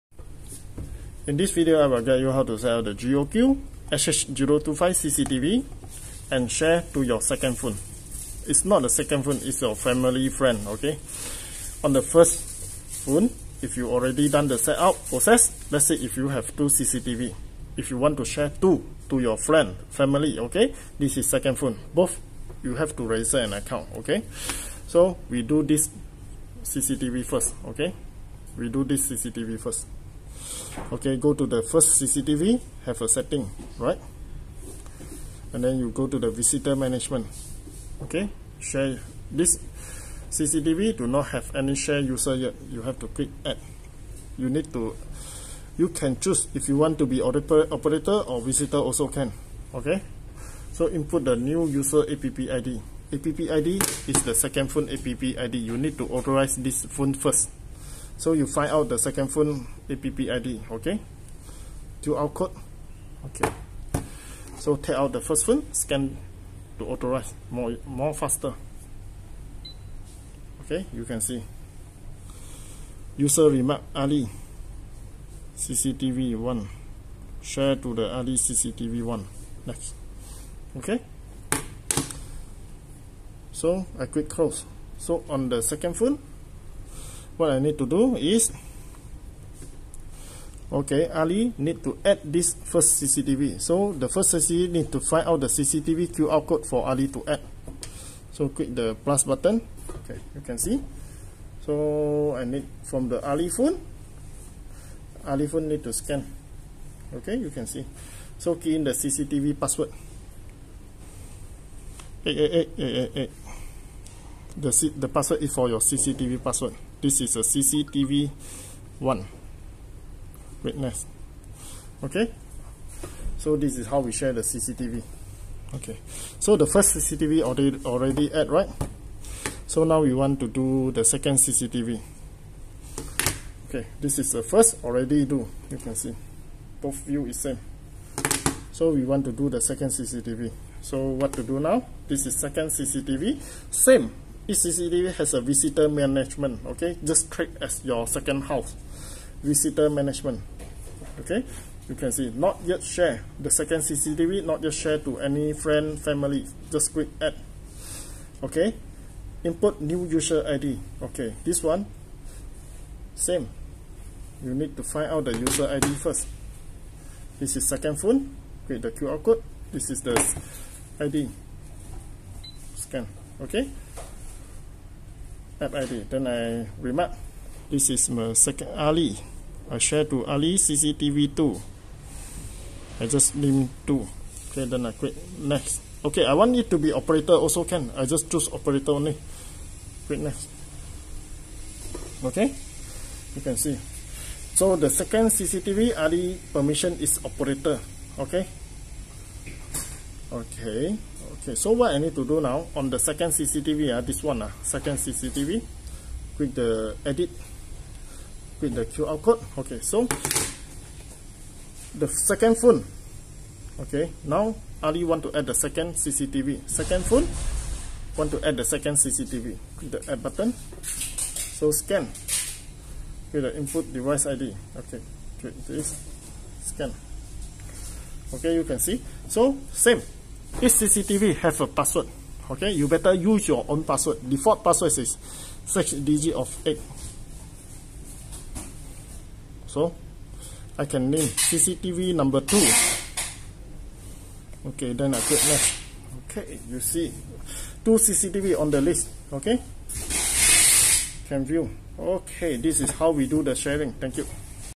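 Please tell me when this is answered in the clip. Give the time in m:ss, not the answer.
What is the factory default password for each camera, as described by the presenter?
3:55.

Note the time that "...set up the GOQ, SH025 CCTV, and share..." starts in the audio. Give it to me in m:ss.
0:02.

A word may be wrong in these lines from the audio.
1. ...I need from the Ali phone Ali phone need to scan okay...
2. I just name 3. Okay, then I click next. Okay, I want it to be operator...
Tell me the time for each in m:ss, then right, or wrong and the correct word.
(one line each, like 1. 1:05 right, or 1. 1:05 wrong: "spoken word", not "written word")
1. 1:42 right
2. 3:02 wrong: "2", not "3".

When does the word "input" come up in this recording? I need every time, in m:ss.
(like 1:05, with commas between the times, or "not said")
0:50, 2:39, 3:43.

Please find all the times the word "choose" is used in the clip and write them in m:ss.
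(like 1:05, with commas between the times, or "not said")
0:46, 3:08.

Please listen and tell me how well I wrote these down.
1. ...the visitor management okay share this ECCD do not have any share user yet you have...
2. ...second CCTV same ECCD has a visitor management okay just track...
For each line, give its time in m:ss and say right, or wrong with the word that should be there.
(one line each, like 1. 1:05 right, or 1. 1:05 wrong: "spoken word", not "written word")
1. 0:36 wrong: "CCTV", not "ECCD"
2. 2:22 right.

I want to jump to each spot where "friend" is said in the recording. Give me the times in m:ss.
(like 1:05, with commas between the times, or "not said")
0:10, 0:19, 2:35.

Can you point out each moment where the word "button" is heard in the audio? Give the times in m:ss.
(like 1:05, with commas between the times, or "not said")
1:39, 3:40.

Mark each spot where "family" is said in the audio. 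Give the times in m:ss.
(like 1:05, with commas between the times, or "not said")
0:09, 0:19, 2:36.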